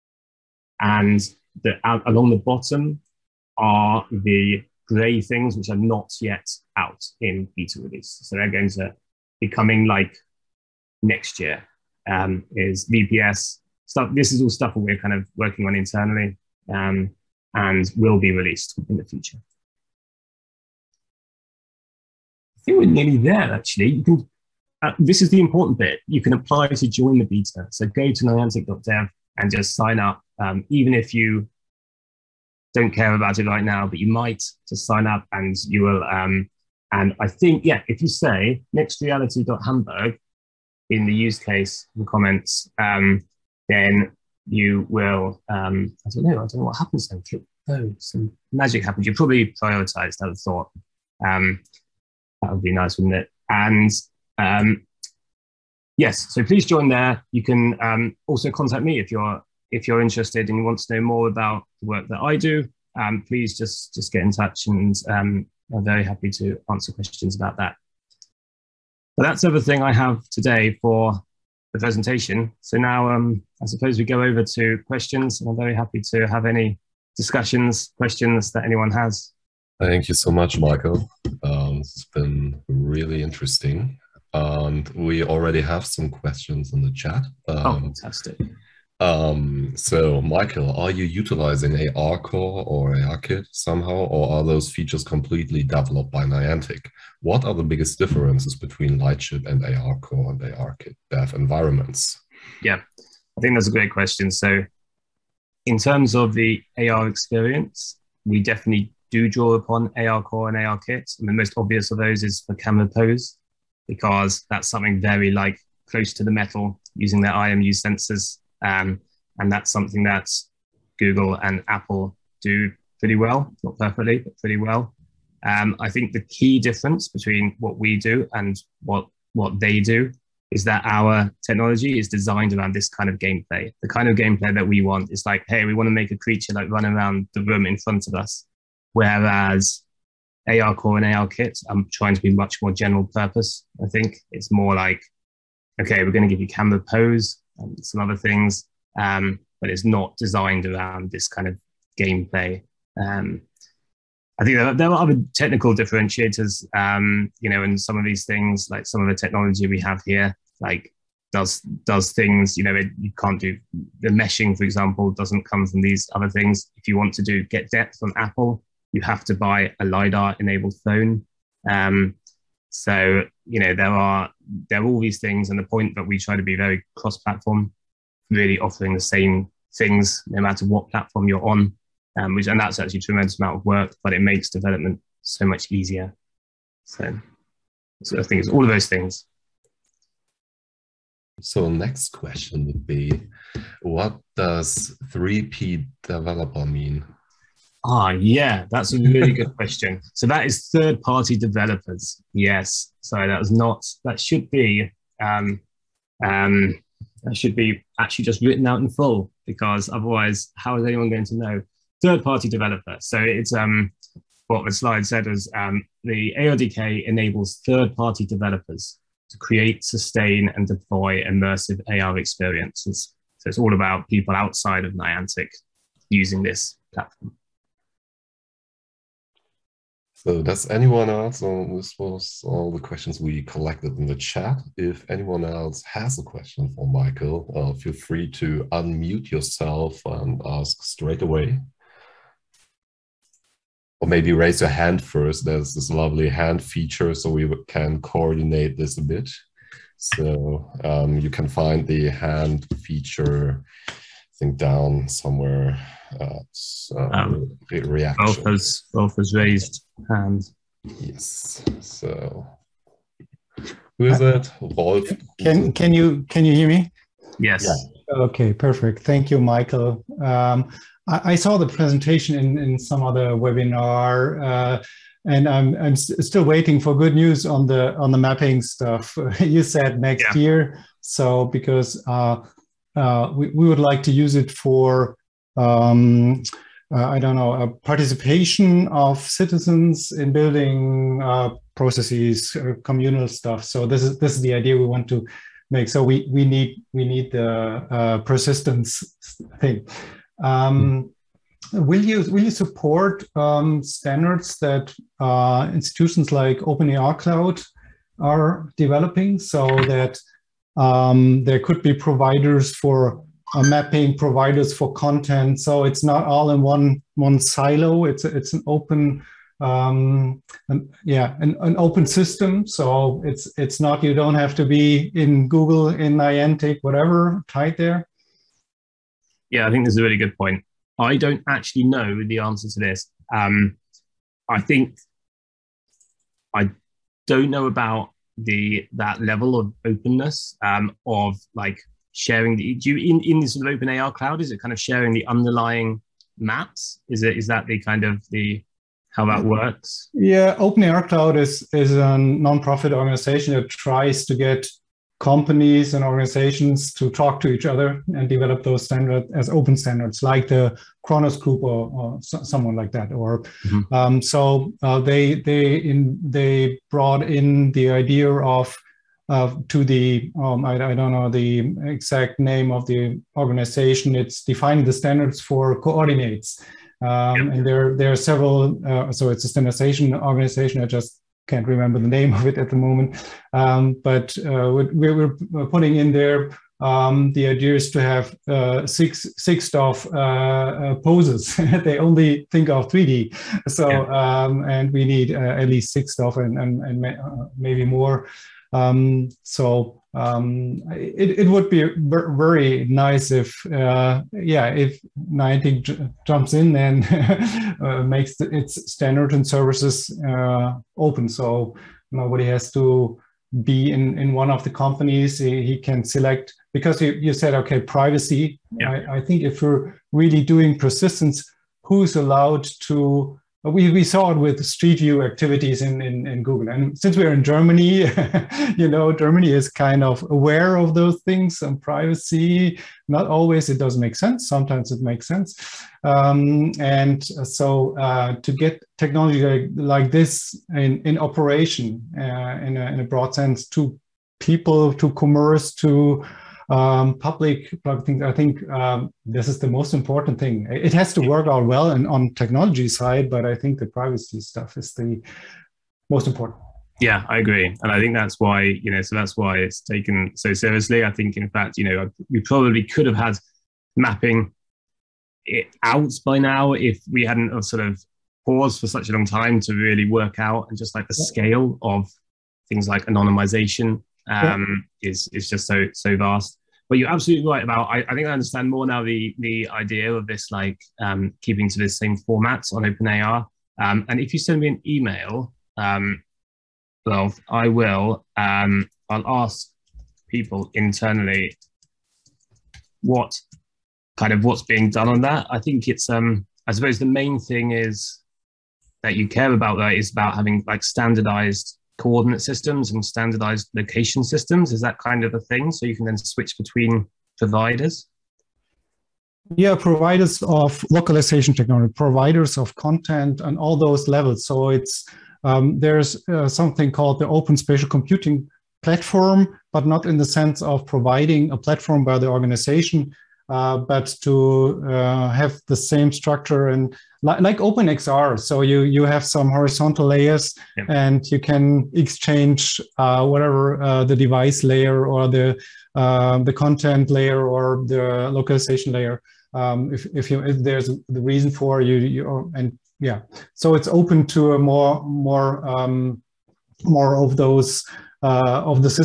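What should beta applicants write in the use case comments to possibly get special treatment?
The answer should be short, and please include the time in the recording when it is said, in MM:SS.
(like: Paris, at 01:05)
nextreality.hamburg, at 00:38.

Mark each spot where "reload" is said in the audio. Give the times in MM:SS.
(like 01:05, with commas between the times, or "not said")
not said.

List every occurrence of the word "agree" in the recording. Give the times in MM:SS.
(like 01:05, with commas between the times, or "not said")
07:37.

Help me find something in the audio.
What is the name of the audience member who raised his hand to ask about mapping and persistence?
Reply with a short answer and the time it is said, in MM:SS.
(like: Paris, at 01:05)
Wolf, at 04:24.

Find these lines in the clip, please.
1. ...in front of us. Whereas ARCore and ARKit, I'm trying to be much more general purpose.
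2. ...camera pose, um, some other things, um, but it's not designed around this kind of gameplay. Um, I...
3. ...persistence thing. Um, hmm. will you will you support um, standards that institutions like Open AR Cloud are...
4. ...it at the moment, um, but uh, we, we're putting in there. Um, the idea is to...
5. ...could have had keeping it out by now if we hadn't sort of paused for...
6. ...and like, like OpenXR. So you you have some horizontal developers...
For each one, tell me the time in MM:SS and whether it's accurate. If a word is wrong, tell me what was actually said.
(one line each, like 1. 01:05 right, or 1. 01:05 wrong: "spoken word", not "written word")
1. 02:17 right
2. 02:26 right
3. 04:58 right
4. 06:22 right
5. 07:42 wrong: "mapping", not "keeping"
6. 08:46 wrong: "layers", not "developers".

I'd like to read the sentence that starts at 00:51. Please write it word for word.
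Um, that would be nice, wouldn't it?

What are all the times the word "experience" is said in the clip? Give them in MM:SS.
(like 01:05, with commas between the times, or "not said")
01:47, 03:42.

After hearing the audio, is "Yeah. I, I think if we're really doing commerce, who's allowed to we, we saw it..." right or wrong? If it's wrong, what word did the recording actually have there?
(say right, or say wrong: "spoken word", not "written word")
wrong: "persistence", not "commerce".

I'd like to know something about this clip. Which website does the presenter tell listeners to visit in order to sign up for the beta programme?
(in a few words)
niantic.dev.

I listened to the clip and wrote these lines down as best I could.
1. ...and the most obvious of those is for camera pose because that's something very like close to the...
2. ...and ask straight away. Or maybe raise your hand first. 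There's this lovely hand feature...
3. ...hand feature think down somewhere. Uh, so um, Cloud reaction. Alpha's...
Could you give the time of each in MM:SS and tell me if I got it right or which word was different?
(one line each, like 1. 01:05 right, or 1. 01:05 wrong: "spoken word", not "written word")
1. 01:51 right
2. 04:00 right
3. 04:12 wrong: "Both", not "Cloud".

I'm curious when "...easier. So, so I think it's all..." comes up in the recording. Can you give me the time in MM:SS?
03:05.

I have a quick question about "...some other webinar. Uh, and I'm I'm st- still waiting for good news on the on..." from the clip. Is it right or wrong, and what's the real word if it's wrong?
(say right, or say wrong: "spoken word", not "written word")
right.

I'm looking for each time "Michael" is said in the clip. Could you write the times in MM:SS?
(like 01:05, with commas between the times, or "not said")
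01:20, 01:30, 03:56, 04:29.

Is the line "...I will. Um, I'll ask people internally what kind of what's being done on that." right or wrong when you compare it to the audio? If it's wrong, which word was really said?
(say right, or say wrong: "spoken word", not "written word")
right.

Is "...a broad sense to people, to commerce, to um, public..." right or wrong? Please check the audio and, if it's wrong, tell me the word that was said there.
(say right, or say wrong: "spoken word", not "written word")
right.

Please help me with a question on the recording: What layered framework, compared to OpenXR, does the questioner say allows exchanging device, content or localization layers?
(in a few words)
Open Spatial Computing Platform.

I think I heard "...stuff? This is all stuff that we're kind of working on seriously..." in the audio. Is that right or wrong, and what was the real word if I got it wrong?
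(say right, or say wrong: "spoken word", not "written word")
wrong: "internally", not "seriously".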